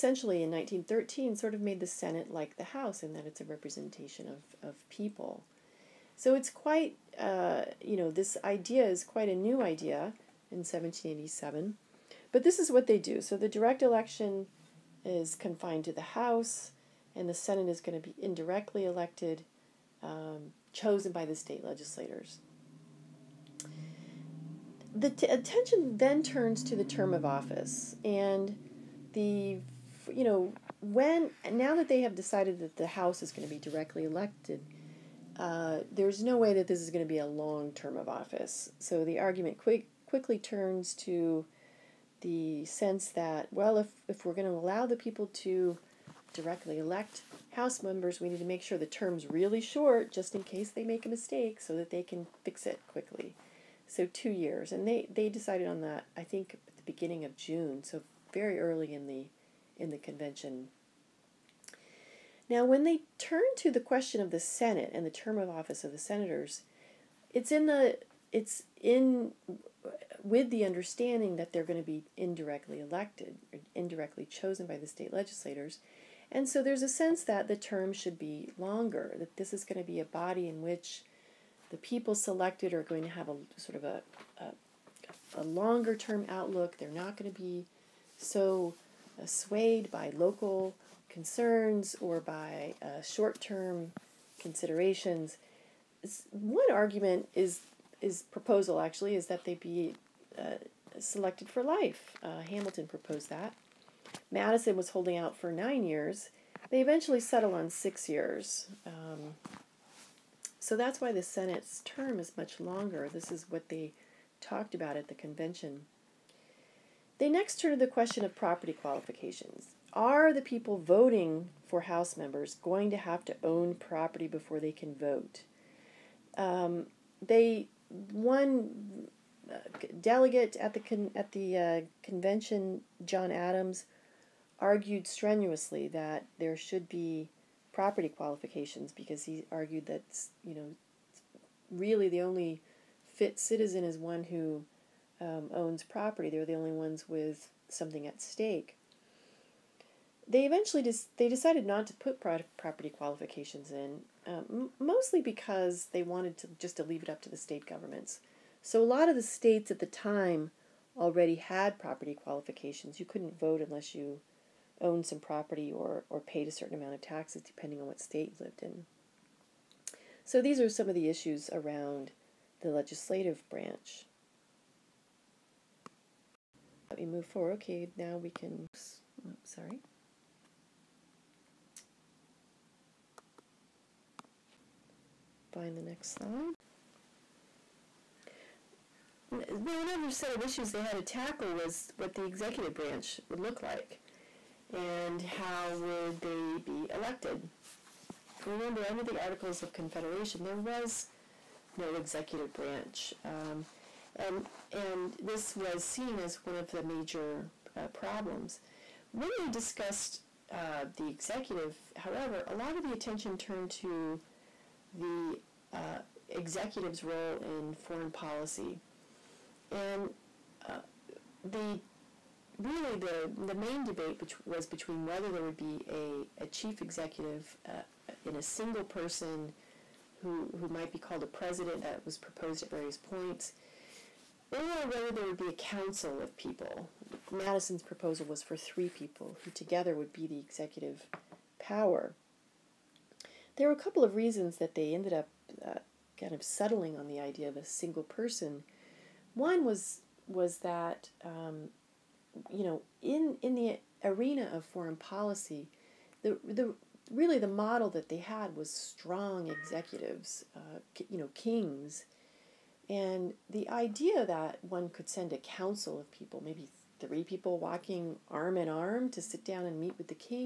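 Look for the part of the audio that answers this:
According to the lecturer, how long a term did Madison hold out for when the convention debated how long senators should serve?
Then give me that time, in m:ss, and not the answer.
1:45.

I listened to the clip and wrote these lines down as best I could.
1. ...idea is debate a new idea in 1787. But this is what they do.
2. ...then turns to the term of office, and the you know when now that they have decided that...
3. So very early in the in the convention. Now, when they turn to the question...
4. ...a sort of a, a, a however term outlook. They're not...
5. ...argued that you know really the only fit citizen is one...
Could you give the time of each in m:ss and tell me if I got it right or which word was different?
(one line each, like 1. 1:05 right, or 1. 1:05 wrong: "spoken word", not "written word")
1. 0:08 wrong: "quite", not "debate"
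2. 0:25 right
3. 0:57 right
4. 1:23 wrong: "longer", not "however"
5. 2:19 right.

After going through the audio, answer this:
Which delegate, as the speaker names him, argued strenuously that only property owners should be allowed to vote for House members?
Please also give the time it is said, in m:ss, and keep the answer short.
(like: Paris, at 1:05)
John Adams, at 2:13.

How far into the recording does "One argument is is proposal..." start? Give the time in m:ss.
1:36.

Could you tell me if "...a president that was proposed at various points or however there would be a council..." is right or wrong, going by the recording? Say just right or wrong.
wrong.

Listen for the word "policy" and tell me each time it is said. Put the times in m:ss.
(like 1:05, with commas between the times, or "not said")
3:38, 4:14.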